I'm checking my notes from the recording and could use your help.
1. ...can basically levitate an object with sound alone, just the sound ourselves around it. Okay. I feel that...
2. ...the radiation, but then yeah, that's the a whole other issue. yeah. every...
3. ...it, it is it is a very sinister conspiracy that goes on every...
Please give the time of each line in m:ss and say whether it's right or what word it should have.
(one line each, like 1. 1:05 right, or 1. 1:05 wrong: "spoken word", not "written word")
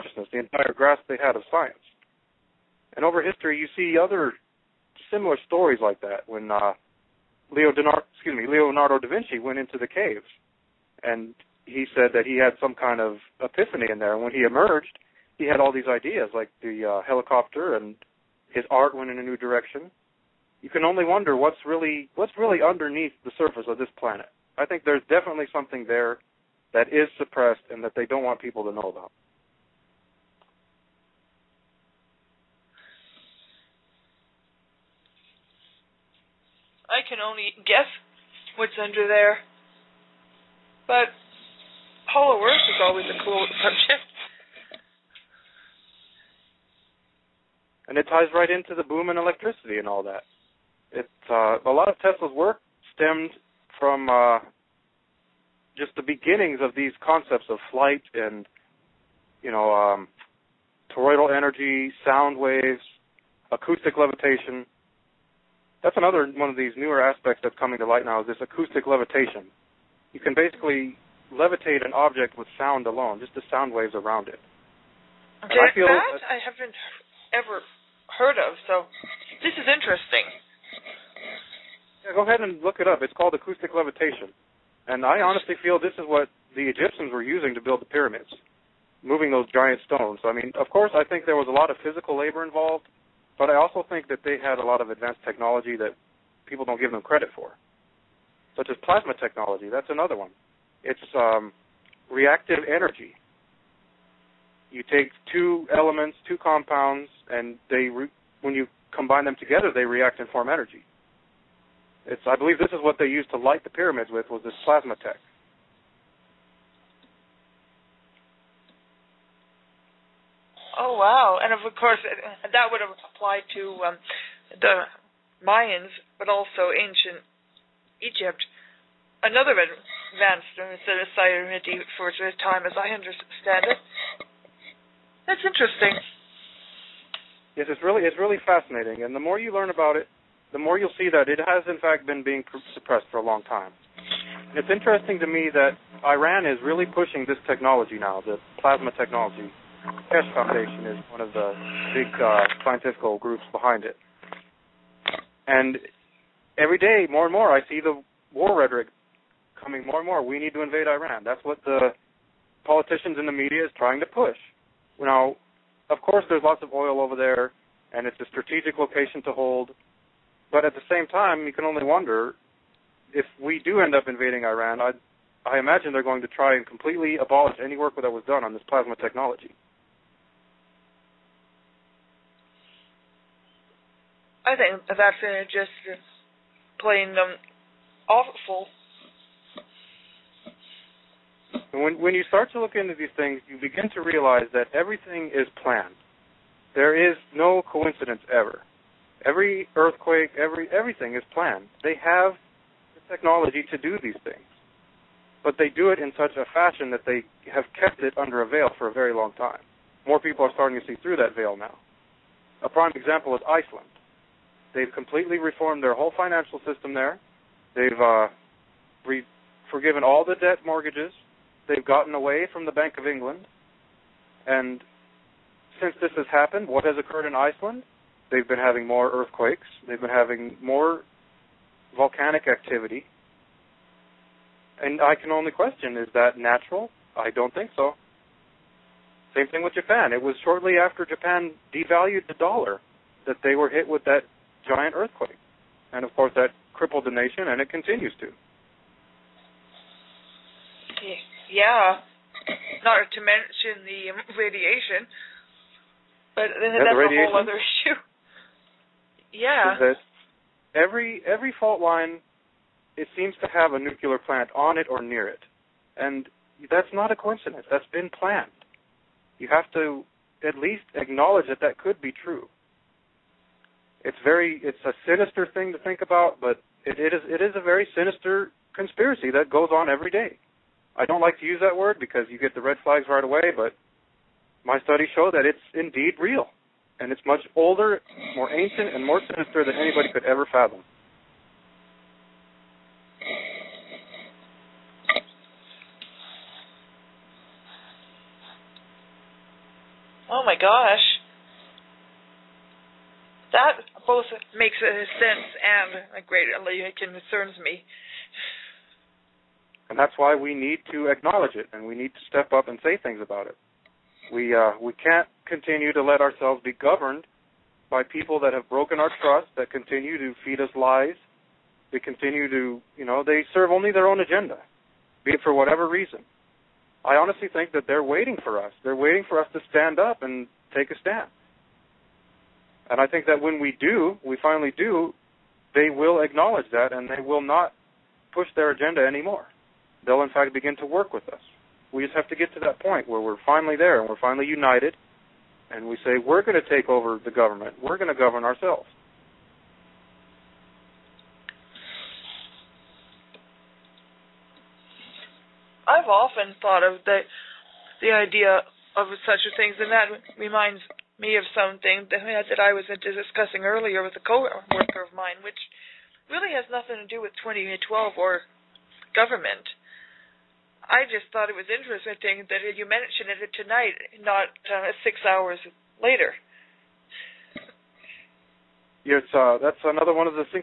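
1. 1:10 wrong: "waves", not "ourselves"
2. 4:13 right
3. 4:36 right.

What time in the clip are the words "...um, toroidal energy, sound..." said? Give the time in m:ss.
0:59.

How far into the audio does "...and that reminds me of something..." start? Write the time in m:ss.
5:59.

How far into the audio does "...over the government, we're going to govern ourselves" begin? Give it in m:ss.
5:46.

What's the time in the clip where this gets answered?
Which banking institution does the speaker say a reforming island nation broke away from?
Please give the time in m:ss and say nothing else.
3:42.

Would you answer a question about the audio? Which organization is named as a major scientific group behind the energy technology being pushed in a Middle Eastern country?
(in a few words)
Keshe Foundation.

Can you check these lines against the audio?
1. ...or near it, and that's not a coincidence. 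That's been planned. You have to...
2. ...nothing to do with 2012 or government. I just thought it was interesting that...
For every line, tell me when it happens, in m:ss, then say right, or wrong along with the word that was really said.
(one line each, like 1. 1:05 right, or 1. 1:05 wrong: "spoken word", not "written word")
1. 4:24 right
2. 6:06 right.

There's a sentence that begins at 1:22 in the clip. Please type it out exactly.
Yeah, go ahead and look it up.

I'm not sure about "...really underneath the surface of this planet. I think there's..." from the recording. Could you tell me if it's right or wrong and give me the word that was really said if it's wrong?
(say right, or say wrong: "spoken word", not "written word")
right.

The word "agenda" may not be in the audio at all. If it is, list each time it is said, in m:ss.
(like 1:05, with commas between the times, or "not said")
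5:24, 5:38.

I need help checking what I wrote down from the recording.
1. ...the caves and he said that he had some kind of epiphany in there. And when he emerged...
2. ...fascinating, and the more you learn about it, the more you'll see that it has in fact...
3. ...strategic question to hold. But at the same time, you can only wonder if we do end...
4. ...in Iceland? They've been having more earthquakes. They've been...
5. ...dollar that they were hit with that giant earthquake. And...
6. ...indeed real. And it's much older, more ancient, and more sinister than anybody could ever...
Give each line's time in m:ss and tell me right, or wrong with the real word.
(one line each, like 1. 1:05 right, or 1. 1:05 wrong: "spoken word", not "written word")
1. 0:09 right
2. 2:18 right
3. 2:48 wrong: "location", not "question"
4. 3:47 right
5. 4:02 right
6. 4:45 right.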